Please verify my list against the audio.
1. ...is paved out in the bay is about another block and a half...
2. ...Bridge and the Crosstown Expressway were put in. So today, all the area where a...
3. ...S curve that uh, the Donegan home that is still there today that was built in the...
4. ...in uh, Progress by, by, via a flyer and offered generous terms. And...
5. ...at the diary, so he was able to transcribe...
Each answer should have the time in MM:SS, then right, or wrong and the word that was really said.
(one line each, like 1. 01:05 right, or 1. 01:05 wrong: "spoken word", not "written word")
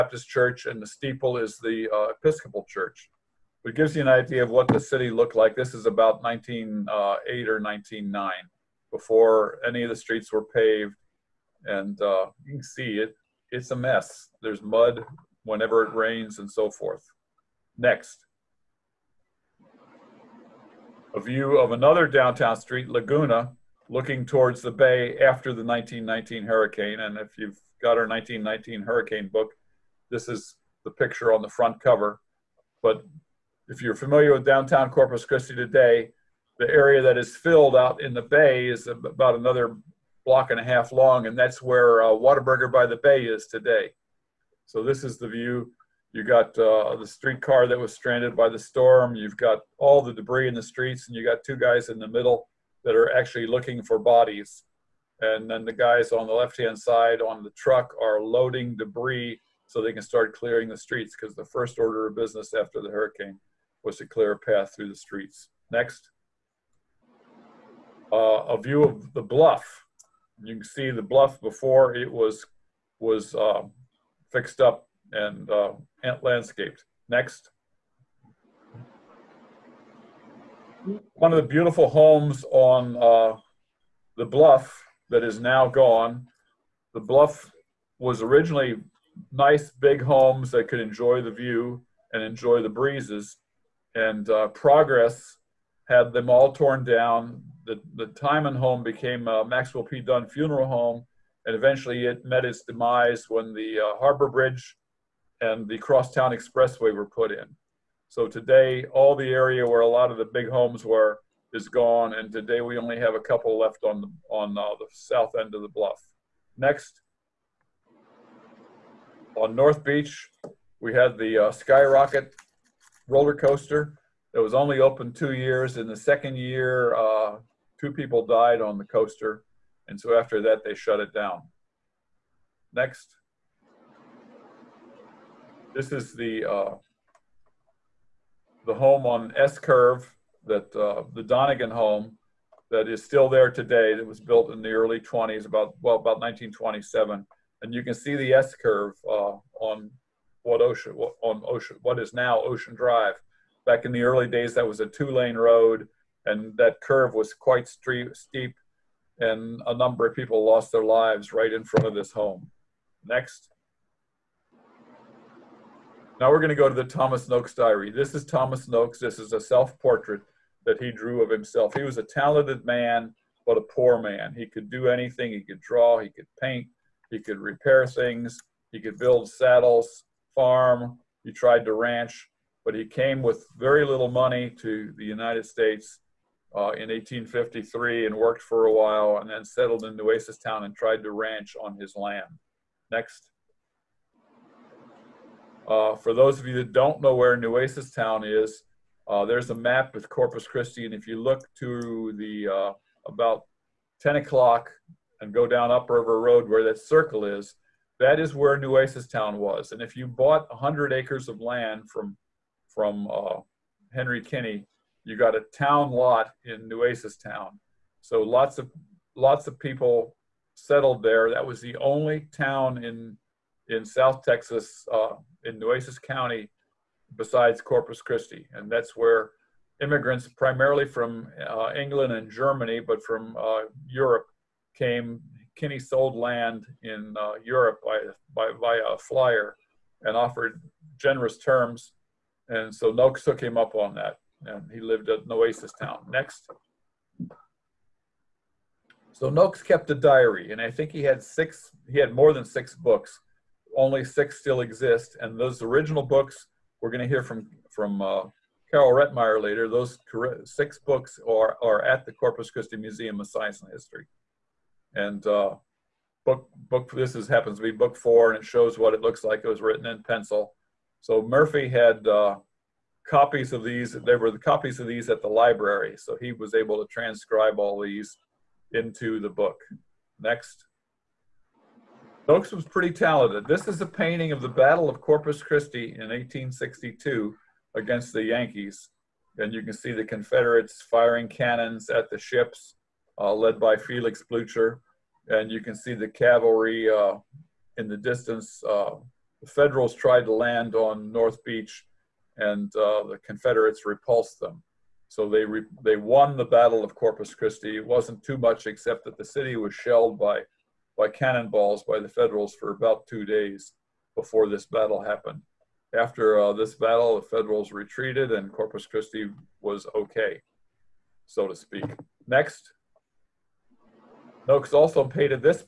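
1. 00:37 wrong: "filled", not "paved"
2. 01:44 right
3. 02:19 right
4. 03:56 wrong: "Europe", not "Progress"
5. 04:35 wrong: "library", not "diary".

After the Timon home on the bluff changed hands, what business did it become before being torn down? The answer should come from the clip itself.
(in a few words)
Maxwell P. Dunn Funeral Home.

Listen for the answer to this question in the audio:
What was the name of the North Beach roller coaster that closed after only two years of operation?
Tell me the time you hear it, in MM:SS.
02:01.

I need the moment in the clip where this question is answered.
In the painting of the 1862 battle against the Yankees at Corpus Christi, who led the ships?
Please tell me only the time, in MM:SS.
04:53.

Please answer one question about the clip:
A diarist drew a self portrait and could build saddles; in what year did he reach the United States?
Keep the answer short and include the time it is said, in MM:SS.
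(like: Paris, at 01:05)
1853, at 03:06.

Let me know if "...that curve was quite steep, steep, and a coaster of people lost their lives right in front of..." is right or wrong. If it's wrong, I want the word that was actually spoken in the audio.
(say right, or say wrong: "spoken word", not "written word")
wrong: "number", not "coaster".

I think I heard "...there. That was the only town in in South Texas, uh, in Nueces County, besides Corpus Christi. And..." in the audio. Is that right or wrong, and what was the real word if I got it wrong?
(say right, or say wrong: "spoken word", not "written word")
right.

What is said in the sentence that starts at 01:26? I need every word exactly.
The bluff was originally nice big homes that could enjoy the view and enjoy the breezes.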